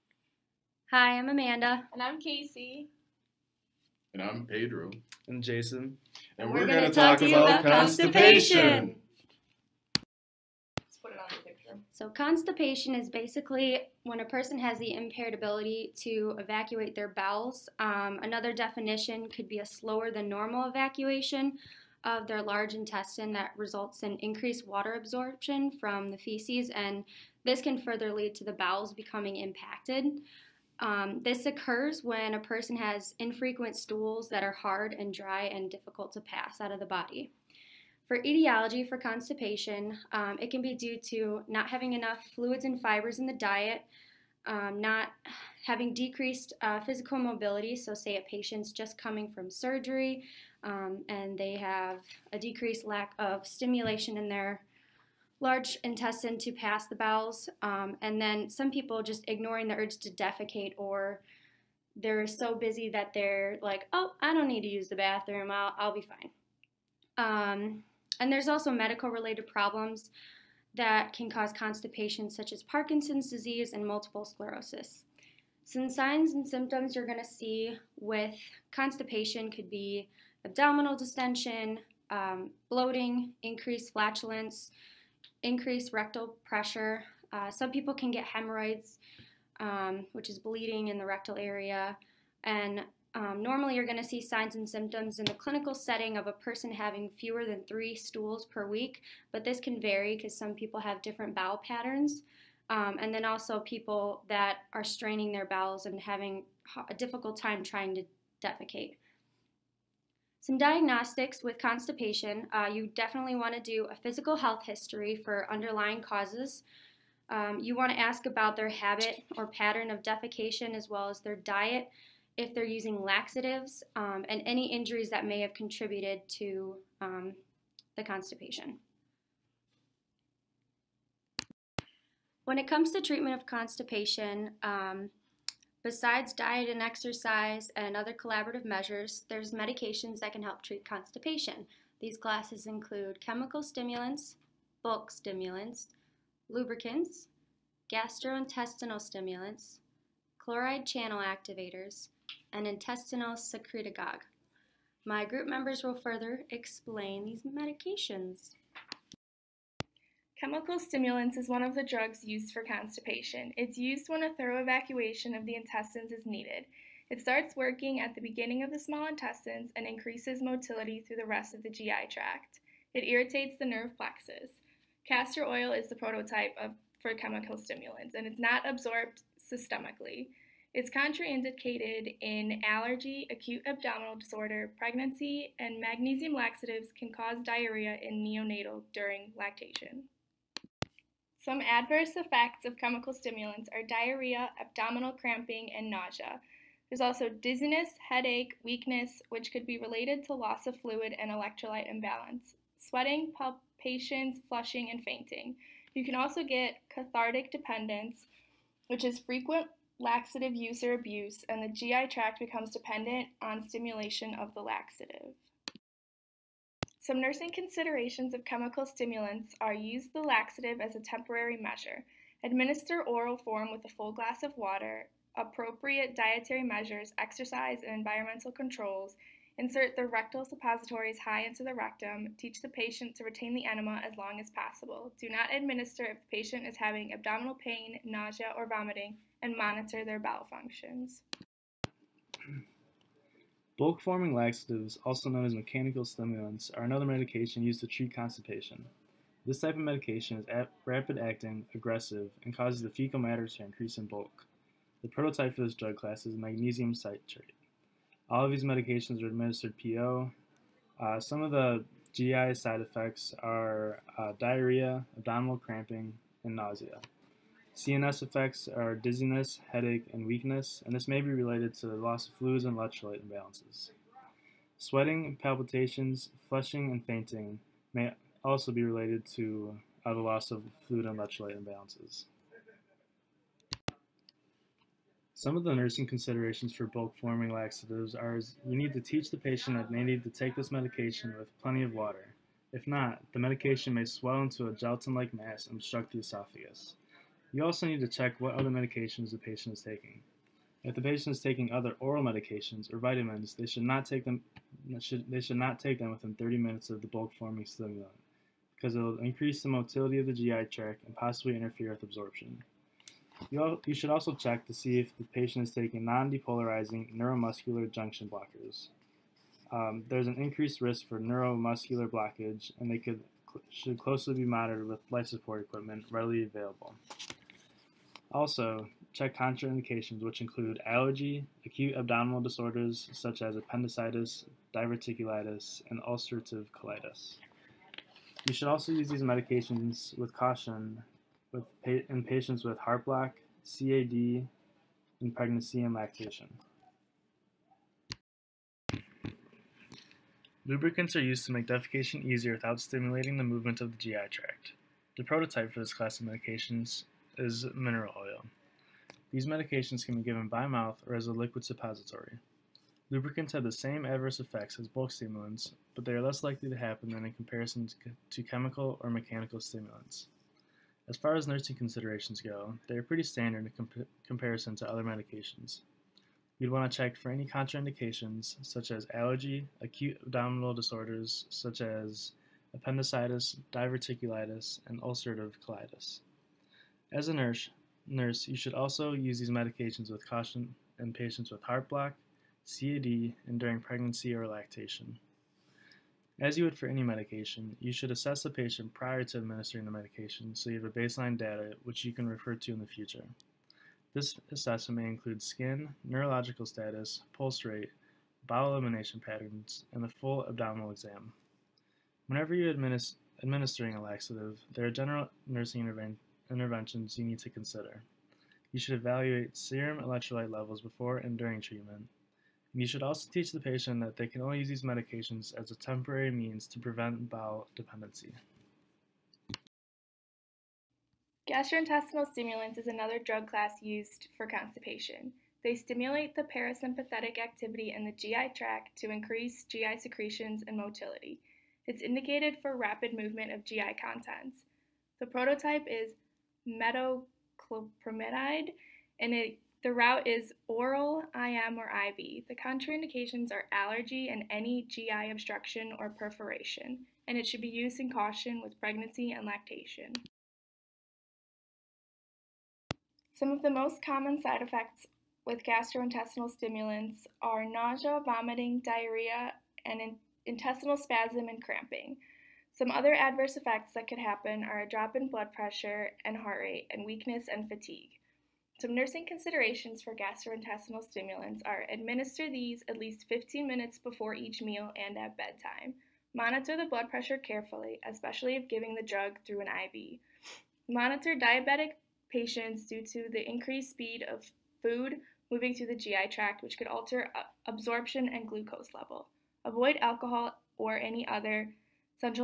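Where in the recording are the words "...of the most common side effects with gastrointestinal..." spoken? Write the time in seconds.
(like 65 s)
463 s.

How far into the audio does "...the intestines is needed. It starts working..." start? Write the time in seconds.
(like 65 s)
165 s.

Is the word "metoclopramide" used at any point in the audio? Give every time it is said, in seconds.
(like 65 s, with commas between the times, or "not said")
446 s.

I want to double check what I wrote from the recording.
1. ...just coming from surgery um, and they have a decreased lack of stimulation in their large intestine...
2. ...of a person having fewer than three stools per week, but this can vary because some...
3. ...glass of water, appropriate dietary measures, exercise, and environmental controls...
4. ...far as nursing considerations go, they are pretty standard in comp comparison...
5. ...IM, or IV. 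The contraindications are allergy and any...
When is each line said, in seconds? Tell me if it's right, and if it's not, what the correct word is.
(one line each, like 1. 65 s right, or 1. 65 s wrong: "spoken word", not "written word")
1. 48 s right
2. 96 s right
3. 224 s right
4. 371 s right
5. 451 s right.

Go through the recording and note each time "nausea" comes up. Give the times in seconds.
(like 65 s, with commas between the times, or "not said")
195 s, 238 s, 266 s, 467 s.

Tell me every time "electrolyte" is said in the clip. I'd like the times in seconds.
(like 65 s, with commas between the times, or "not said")
201 s, 272 s, 281 s, 420 s.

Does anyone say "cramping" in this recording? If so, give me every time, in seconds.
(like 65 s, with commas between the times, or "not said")
195 s, 265 s, 471 s.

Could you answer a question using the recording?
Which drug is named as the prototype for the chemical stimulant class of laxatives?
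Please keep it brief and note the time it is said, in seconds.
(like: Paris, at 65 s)
Castor oil, at 175 s.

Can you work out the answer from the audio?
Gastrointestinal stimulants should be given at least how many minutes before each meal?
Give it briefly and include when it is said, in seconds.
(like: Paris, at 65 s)
15 minutes, at 483 s.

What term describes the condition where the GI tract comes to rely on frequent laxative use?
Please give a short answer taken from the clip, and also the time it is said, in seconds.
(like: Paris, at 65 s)
Cathartic dependence, at 206 s.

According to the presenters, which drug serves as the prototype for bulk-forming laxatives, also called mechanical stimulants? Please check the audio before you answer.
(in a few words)
Magnesium citrate.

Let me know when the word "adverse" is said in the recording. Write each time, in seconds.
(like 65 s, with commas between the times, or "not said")
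191 s, 364 s, 473 s.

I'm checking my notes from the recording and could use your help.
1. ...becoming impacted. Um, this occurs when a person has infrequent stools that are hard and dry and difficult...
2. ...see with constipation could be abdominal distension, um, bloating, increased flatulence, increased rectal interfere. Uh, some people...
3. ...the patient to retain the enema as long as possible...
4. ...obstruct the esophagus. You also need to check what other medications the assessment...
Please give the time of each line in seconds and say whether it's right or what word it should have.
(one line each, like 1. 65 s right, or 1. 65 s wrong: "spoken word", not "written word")
1. 28 s right
2. 77 s wrong: "pressure", not "interfere"
3. 232 s right
4. 295 s wrong: "patient", not "assessment".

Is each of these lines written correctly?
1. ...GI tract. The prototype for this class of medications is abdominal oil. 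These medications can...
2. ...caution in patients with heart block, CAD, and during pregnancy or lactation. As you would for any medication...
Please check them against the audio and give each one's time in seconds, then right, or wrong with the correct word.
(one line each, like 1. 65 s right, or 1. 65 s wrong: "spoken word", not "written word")
1. 353 s wrong: "mineral", not "abdominal"
2. 390 s right.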